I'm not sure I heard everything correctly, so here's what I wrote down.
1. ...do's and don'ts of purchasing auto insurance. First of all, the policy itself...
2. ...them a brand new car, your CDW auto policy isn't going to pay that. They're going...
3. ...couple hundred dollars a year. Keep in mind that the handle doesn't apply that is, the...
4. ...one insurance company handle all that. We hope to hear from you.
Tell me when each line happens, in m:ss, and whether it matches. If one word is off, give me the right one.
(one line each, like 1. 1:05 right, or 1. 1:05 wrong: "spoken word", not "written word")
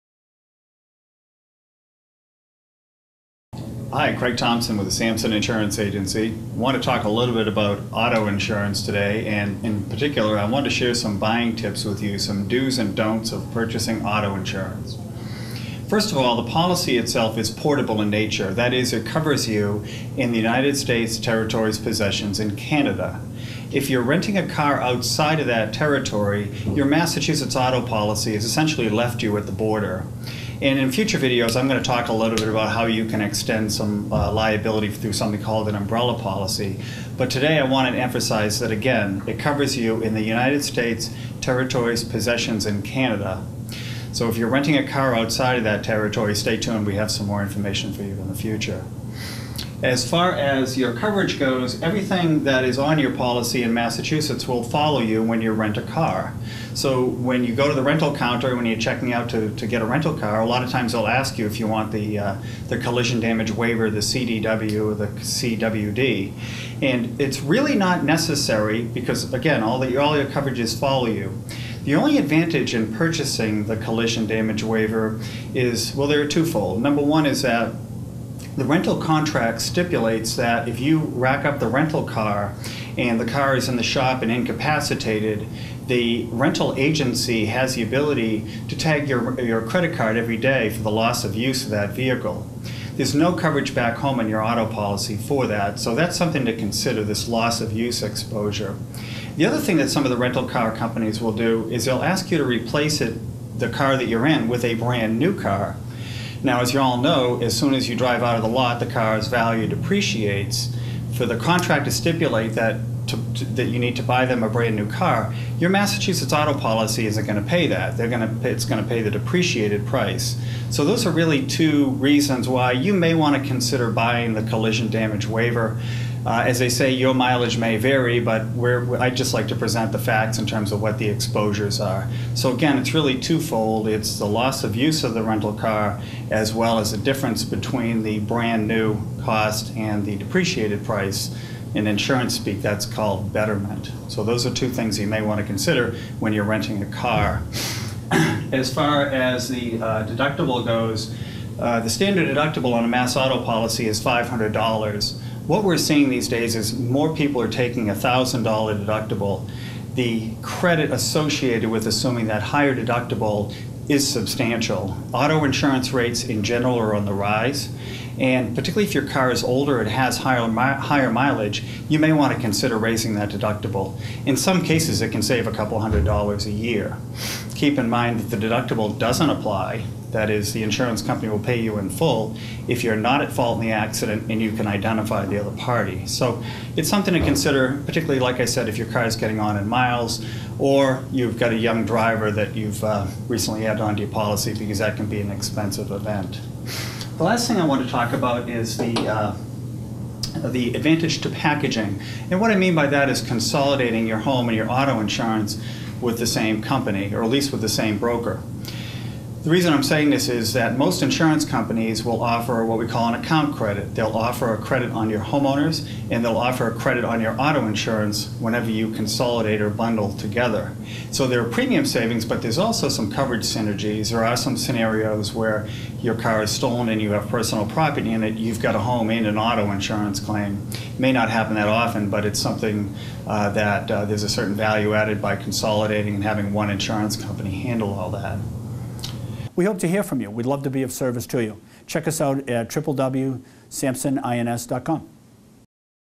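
1. 0:12 right
2. 1:54 wrong: "Massachusetts", not "CDW"
3. 2:55 wrong: "deductible", not "handle"
4. 3:56 right.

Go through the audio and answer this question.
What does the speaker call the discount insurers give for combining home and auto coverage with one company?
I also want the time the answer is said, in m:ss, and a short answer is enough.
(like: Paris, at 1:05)
account credit, at 3:33.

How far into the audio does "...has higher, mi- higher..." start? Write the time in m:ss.
2:49.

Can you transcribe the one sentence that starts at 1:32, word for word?
There's no coverage back home in your auto policy for that, so that's something to consider this loss of use exposure.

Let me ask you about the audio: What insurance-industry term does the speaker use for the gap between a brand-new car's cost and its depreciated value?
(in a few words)
betterment.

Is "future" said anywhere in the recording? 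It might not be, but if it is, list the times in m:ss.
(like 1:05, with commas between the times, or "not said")
0:30, 0:48.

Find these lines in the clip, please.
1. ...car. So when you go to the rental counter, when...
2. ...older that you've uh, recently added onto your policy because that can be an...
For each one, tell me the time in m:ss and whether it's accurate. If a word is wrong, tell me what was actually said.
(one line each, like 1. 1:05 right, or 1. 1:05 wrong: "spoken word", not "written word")
1. 0:55 right
2. 3:11 wrong: "driver", not "older".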